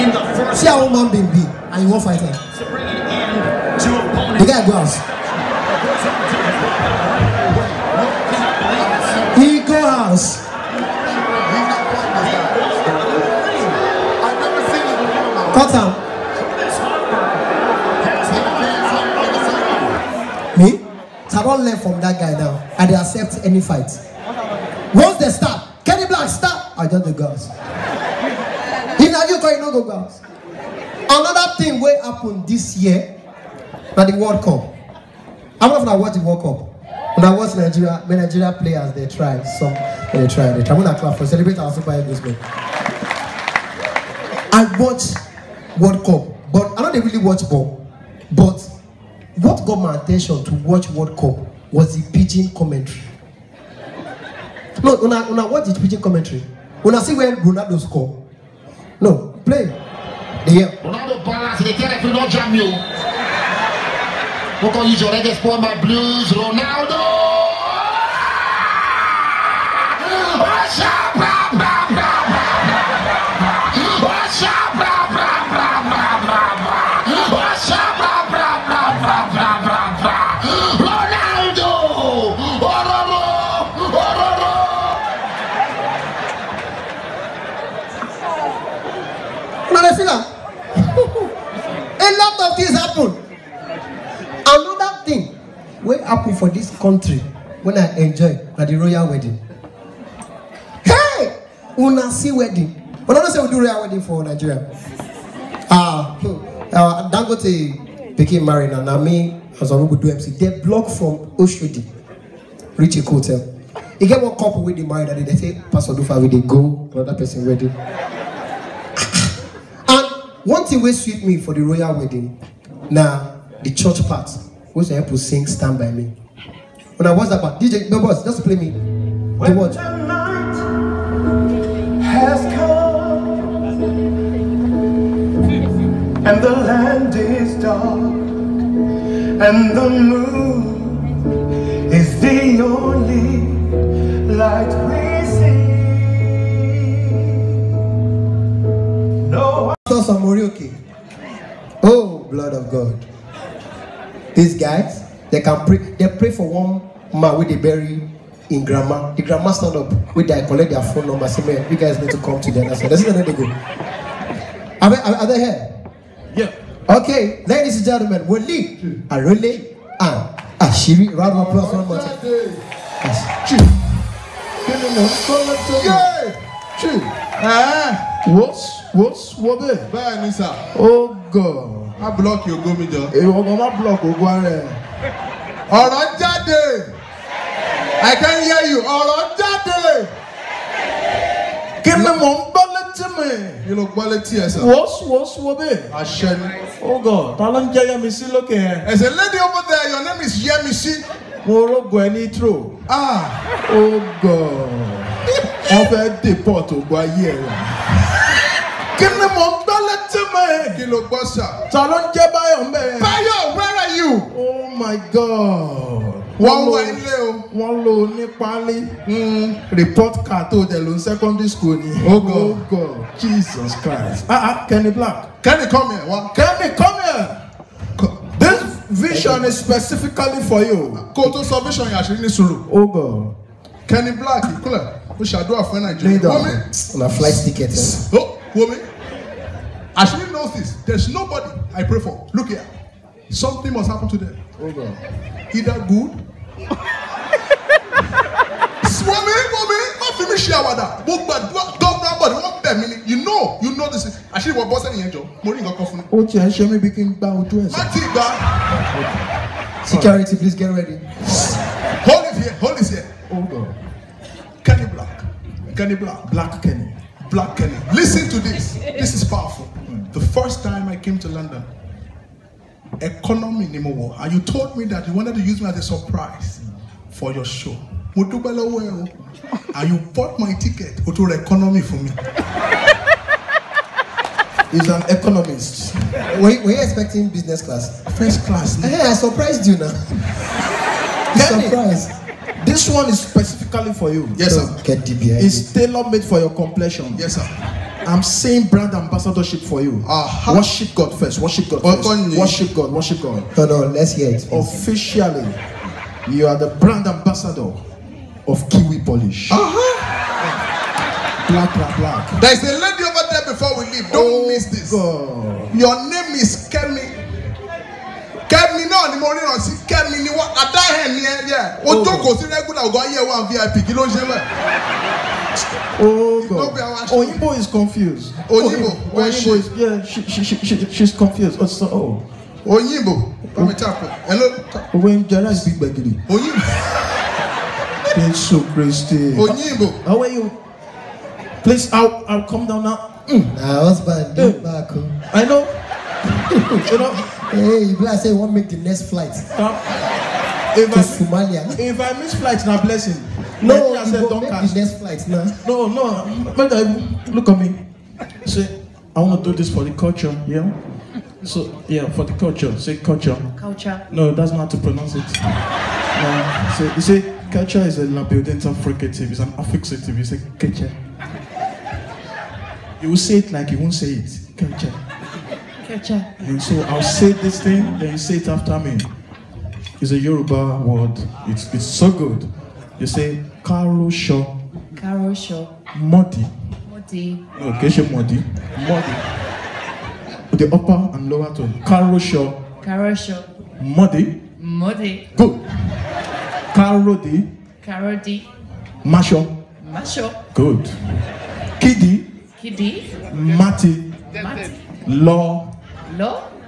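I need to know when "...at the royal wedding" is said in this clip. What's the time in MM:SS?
01:38.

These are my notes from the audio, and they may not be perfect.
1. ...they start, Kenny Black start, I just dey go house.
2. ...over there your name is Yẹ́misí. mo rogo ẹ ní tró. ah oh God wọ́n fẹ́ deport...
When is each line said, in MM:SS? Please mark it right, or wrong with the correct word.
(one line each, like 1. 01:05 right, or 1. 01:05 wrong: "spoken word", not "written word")
1. 00:25 right
2. 03:19 right.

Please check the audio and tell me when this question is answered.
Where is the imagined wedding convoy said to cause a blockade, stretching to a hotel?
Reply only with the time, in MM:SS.
01:51.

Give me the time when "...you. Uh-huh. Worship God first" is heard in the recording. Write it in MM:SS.
04:59.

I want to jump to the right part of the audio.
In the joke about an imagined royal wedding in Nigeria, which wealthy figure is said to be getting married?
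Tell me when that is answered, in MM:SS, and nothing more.
01:47.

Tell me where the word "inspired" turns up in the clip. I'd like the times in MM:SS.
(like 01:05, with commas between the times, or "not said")
not said.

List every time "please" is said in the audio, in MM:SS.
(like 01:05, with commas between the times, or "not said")
04:20, 05:41.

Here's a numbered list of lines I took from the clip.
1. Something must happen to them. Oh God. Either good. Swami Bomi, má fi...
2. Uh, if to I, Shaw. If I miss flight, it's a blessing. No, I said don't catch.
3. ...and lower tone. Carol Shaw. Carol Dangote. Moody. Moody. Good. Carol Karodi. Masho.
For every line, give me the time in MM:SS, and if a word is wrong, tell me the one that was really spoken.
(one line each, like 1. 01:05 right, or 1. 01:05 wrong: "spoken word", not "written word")
1. 04:03 right
2. 05:49 wrong: "Somalia", not "Shaw"
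3. 06:31 wrong: "Shaw", not "Dangote".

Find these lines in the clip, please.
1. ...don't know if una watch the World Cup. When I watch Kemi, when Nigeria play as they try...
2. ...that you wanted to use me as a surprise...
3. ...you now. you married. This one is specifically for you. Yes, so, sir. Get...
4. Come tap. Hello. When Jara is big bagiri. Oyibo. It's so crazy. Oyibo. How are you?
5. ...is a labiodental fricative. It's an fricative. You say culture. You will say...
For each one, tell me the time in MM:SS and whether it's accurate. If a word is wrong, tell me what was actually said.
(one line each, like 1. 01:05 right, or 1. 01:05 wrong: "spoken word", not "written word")
1. 00:35 wrong: "Nigeria", not "Kemi"
2. 04:34 right
3. 04:49 wrong: "surprised", not "married"
4. 05:33 right
5. 06:07 wrong: "affixative", not "fricative".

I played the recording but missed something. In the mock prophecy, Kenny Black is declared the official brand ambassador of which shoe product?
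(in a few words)
Kiwi Polish.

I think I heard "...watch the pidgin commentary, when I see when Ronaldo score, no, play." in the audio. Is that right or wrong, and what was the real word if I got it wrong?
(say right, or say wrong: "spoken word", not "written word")
right.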